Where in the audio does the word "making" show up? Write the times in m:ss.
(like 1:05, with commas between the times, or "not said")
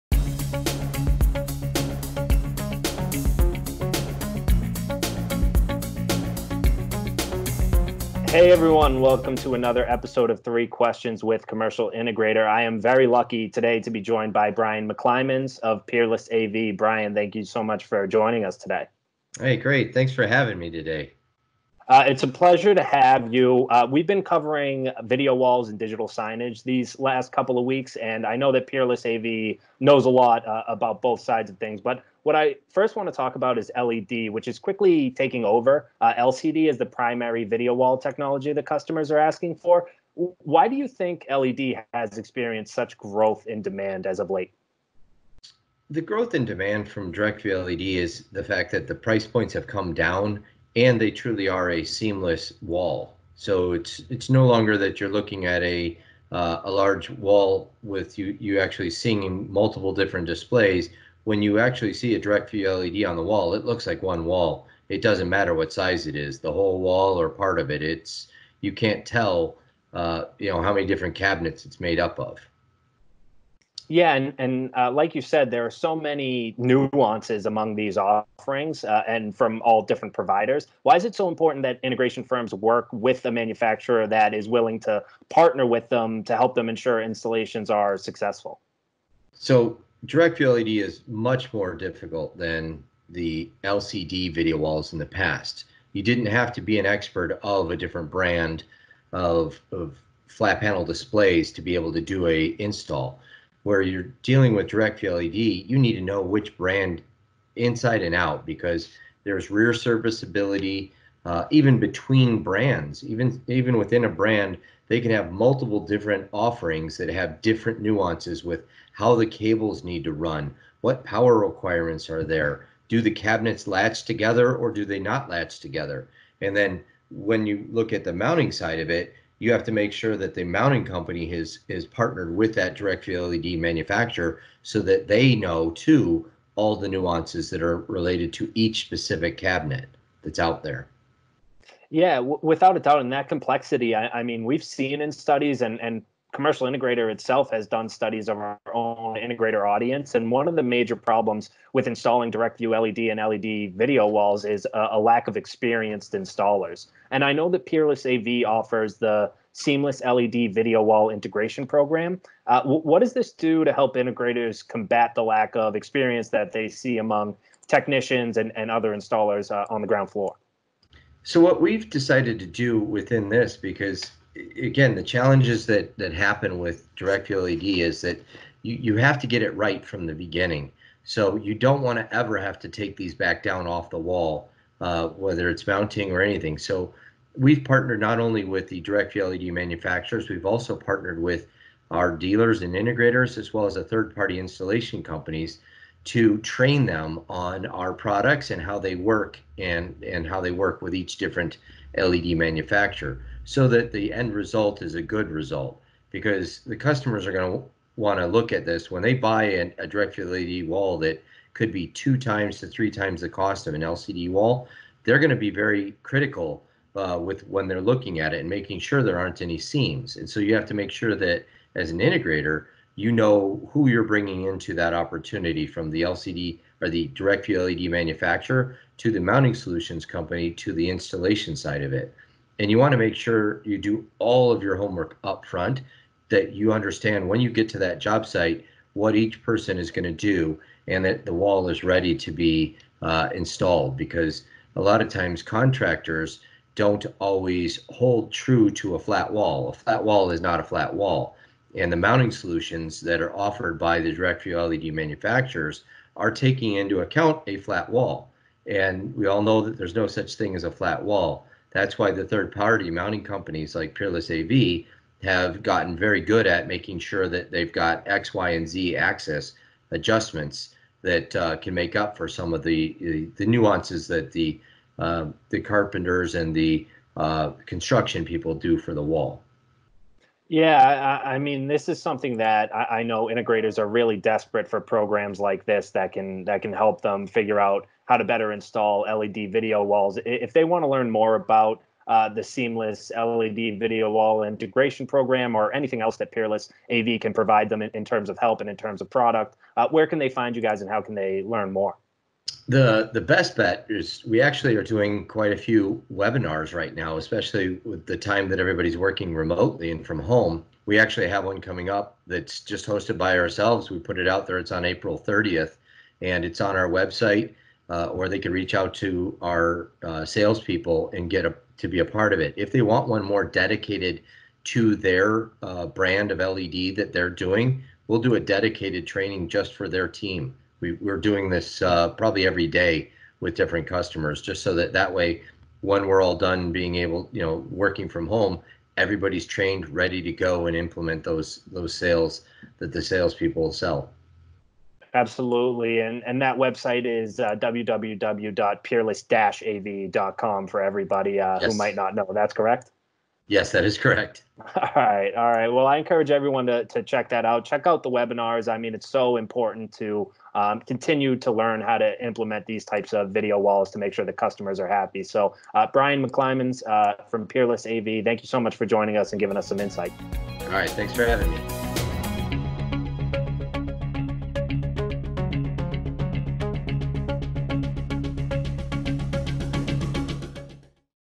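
3:38, 4:26.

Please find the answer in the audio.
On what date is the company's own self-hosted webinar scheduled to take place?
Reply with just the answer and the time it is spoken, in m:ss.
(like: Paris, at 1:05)
April 30th, at 5:14.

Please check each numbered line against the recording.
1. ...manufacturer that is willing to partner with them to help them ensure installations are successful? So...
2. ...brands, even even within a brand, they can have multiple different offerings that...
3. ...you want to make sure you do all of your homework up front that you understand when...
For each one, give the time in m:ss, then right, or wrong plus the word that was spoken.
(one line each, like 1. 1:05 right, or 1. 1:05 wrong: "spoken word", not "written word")
1. 1:23 right
2. 1:52 right
3. 3:52 right.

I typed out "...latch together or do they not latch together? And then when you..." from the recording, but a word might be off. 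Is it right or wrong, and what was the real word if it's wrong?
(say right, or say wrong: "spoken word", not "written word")
right.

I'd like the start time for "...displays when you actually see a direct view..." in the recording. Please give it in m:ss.
1:00.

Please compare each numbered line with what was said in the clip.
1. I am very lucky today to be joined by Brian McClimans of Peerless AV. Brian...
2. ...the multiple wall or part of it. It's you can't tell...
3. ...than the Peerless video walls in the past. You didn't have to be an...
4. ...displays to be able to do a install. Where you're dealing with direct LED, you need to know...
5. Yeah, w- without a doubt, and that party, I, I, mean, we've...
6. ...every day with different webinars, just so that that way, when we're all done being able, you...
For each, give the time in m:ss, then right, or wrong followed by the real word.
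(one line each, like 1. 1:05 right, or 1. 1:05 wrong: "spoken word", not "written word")
1. 0:12 right
2. 1:06 wrong: "whole", not "multiple"
3. 1:32 wrong: "LCD", not "Peerless"
4. 1:40 right
5. 2:21 wrong: "complexity", not "party"
6. 5:32 wrong: "customers", not "webinars".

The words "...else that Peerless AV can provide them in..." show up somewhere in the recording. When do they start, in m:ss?
4:56.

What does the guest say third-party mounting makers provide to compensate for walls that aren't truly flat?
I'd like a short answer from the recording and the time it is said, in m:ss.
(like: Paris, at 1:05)
X, Y, and Z axis adjustments, at 4:28.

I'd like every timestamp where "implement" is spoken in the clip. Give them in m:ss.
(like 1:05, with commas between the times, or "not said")
5:40, 6:02.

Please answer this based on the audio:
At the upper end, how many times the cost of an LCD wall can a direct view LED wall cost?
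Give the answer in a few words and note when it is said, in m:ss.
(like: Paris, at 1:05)
3 times, at 3:32.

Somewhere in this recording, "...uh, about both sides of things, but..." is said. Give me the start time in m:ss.
0:30.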